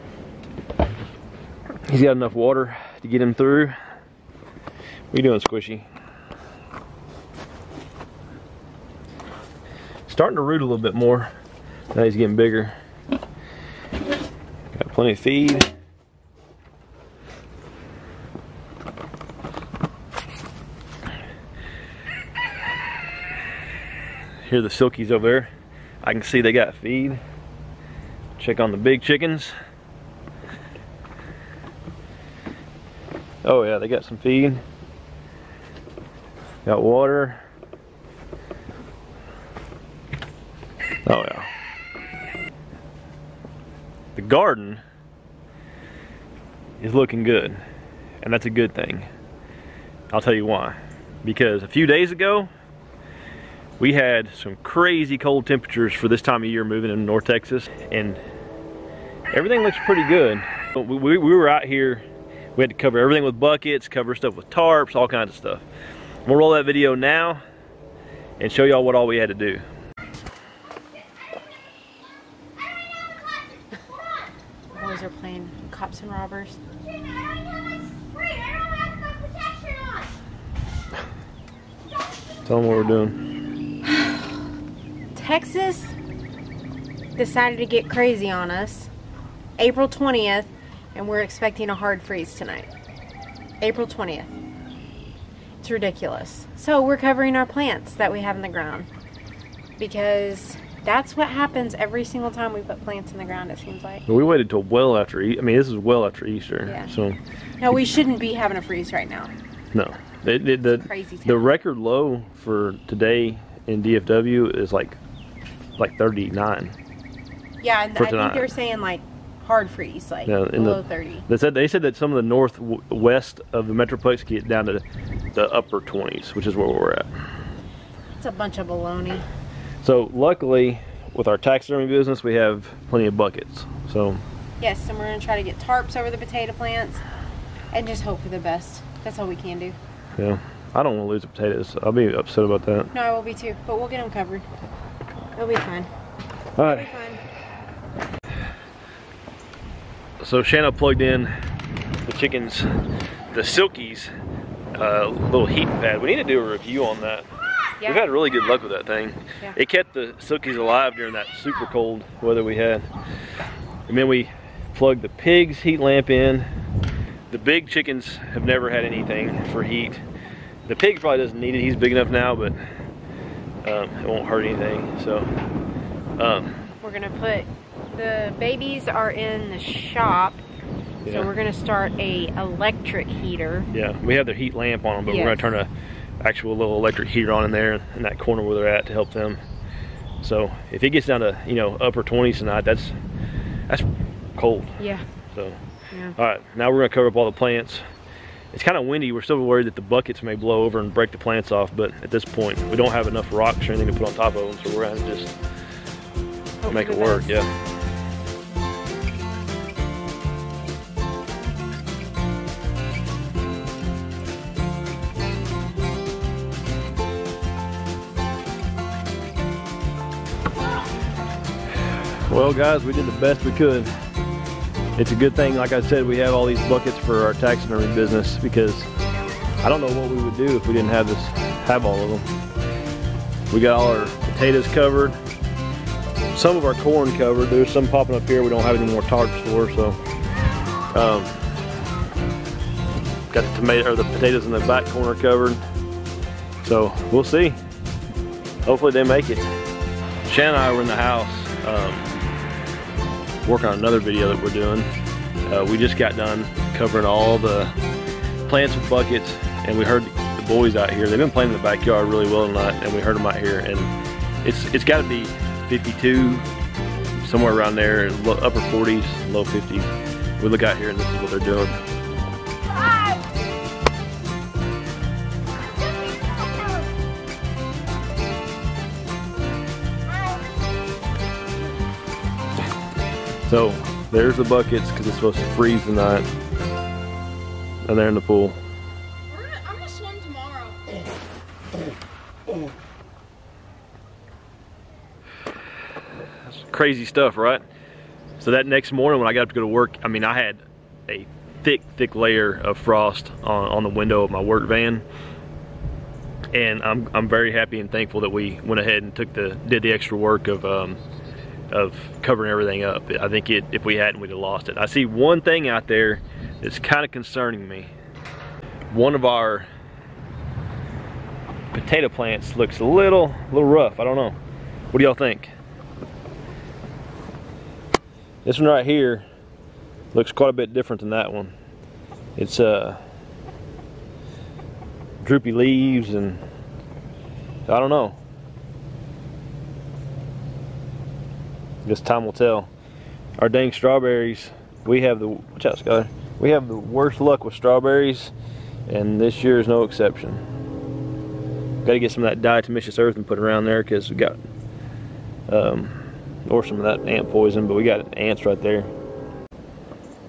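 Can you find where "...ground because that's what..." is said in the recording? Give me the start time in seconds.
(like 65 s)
98 s.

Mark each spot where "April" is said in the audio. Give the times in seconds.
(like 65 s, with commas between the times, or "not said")
89 s, 93 s.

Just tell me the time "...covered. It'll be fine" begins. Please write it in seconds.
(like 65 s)
144 s.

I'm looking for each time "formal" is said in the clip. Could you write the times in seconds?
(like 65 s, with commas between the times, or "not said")
not said.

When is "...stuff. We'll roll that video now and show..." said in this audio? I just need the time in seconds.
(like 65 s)
65 s.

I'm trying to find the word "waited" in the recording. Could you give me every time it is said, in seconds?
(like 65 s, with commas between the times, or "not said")
104 s.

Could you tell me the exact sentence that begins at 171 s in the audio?
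He's big enough now, but um, it won't hurt anything.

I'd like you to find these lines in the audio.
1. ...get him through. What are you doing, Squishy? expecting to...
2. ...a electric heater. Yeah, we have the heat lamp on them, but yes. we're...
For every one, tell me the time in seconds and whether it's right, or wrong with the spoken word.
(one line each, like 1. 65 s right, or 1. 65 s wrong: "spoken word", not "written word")
1. 3 s wrong: "starting", not "expecting"
2. 181 s right.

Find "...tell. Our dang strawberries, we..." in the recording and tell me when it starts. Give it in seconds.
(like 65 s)
342 s.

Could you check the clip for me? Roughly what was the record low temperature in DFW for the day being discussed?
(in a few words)
39.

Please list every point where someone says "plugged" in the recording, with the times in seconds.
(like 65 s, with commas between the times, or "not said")
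150 s, 164 s.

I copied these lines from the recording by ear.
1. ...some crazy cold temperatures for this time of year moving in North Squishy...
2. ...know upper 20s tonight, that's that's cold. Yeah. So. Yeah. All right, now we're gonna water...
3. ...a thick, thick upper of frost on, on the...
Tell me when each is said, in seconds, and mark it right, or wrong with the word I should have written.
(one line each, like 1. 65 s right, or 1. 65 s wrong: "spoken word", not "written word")
1. 54 s wrong: "Texas", not "Squishy"
2. 191 s wrong: "cover", not "water"
3. 301 s wrong: "layer", not "upper".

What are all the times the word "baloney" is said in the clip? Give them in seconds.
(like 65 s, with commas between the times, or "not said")
128 s.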